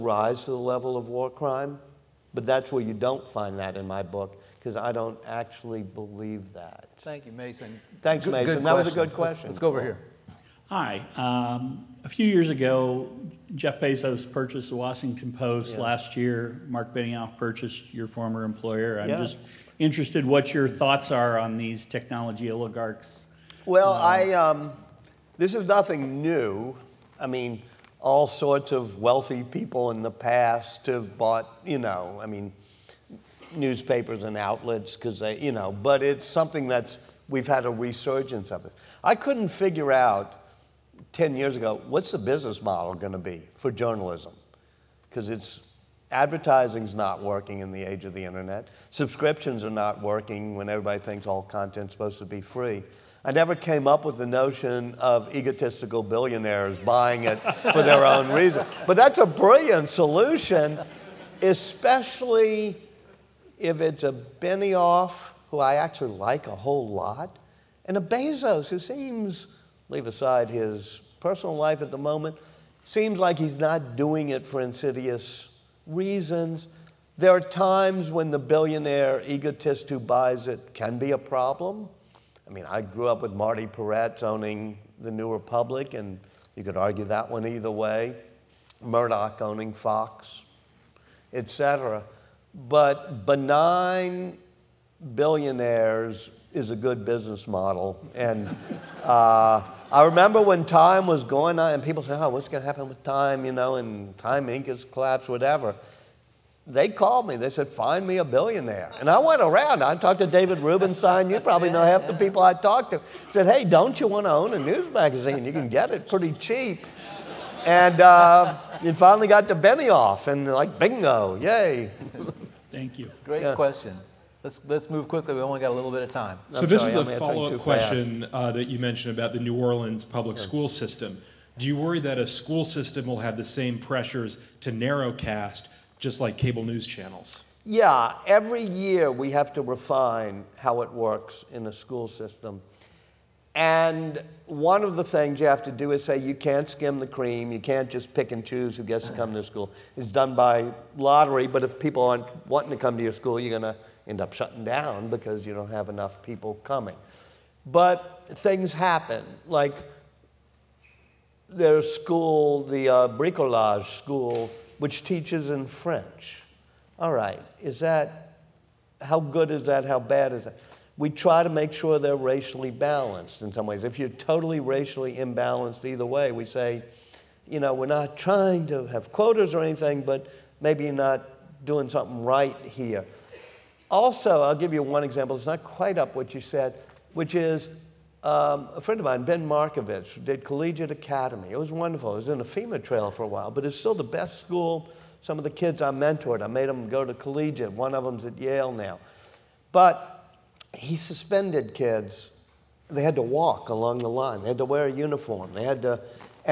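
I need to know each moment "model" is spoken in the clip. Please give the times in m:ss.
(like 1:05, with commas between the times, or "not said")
0:42, 1:37.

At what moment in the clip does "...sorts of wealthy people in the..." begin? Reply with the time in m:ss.
0:28.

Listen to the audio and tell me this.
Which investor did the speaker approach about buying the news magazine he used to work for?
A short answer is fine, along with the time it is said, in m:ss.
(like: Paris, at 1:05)
David Rubenstein, at 1:50.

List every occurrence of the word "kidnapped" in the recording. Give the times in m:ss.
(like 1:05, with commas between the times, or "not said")
not said.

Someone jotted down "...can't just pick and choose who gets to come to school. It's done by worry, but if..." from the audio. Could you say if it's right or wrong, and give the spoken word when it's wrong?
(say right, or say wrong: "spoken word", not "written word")
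wrong: "lottery", not "worry".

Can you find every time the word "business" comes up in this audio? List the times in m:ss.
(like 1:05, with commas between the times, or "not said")
0:42, 1:37.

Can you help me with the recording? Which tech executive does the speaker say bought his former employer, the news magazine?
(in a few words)
Mark Benioff.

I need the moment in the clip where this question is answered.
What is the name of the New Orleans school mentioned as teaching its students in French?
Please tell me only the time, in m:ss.
2:43.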